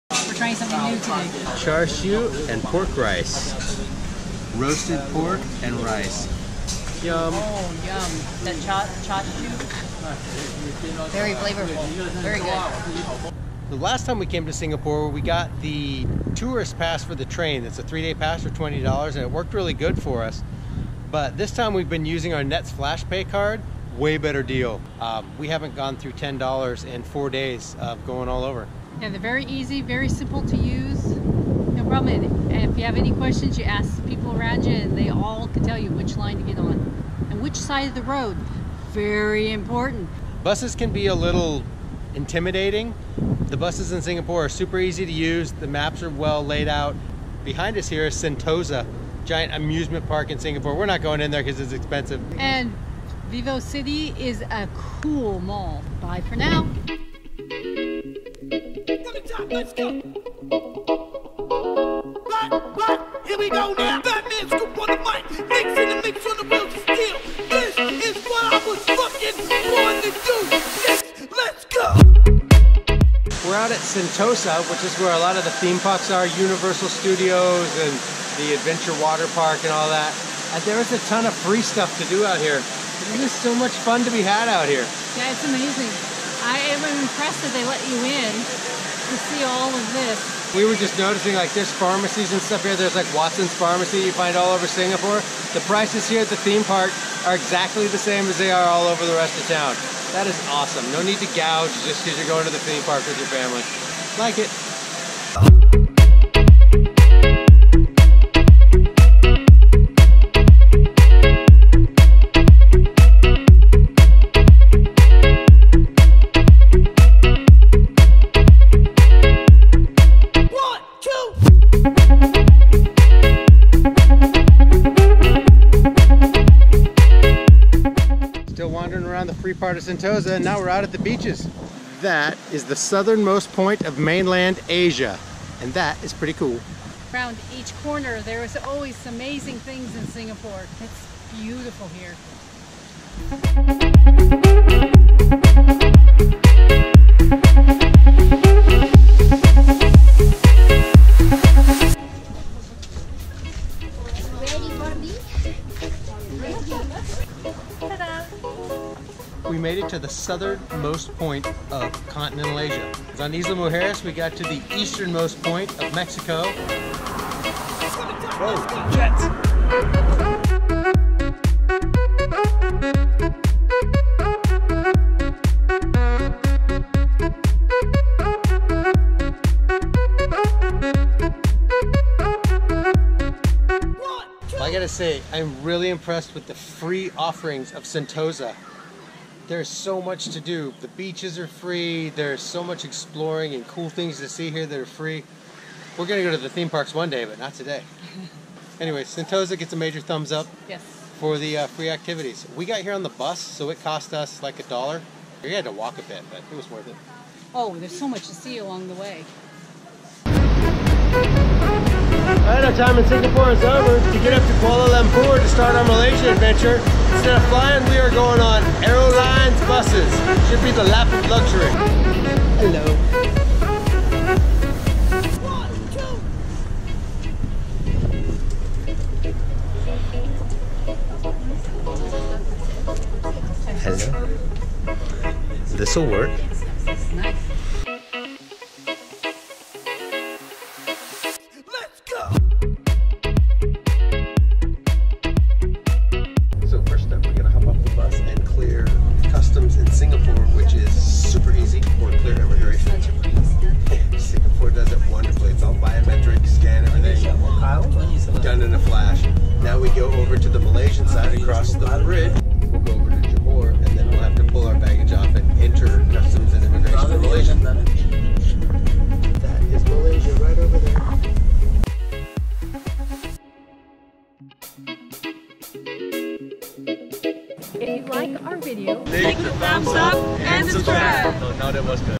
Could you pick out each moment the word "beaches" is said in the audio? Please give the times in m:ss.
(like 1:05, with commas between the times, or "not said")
2:10, 3:10.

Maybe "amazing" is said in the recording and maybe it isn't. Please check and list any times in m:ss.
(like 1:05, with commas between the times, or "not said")
1:25, 2:19.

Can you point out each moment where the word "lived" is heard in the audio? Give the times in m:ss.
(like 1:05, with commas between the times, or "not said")
not said.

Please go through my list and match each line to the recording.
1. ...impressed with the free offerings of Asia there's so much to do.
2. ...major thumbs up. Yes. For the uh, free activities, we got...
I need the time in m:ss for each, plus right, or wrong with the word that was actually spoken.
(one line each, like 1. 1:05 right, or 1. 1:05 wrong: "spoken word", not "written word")
1. 3:05 wrong: "Sentosa", not "Asia"
2. 3:19 right.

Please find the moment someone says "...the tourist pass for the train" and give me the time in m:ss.
0:15.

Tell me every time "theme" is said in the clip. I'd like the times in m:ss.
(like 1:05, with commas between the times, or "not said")
1:15, 1:36, 1:42, 3:16.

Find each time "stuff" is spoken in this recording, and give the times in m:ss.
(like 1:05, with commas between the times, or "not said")
1:21, 1:32.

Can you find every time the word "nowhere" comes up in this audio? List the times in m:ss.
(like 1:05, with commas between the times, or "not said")
not said.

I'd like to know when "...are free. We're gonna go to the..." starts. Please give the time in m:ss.
3:14.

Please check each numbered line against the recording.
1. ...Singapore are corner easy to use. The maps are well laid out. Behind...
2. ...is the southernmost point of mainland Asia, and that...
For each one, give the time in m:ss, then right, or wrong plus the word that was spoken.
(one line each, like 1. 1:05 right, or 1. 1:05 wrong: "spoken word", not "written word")
1. 0:44 wrong: "super", not "corner"
2. 2:12 right.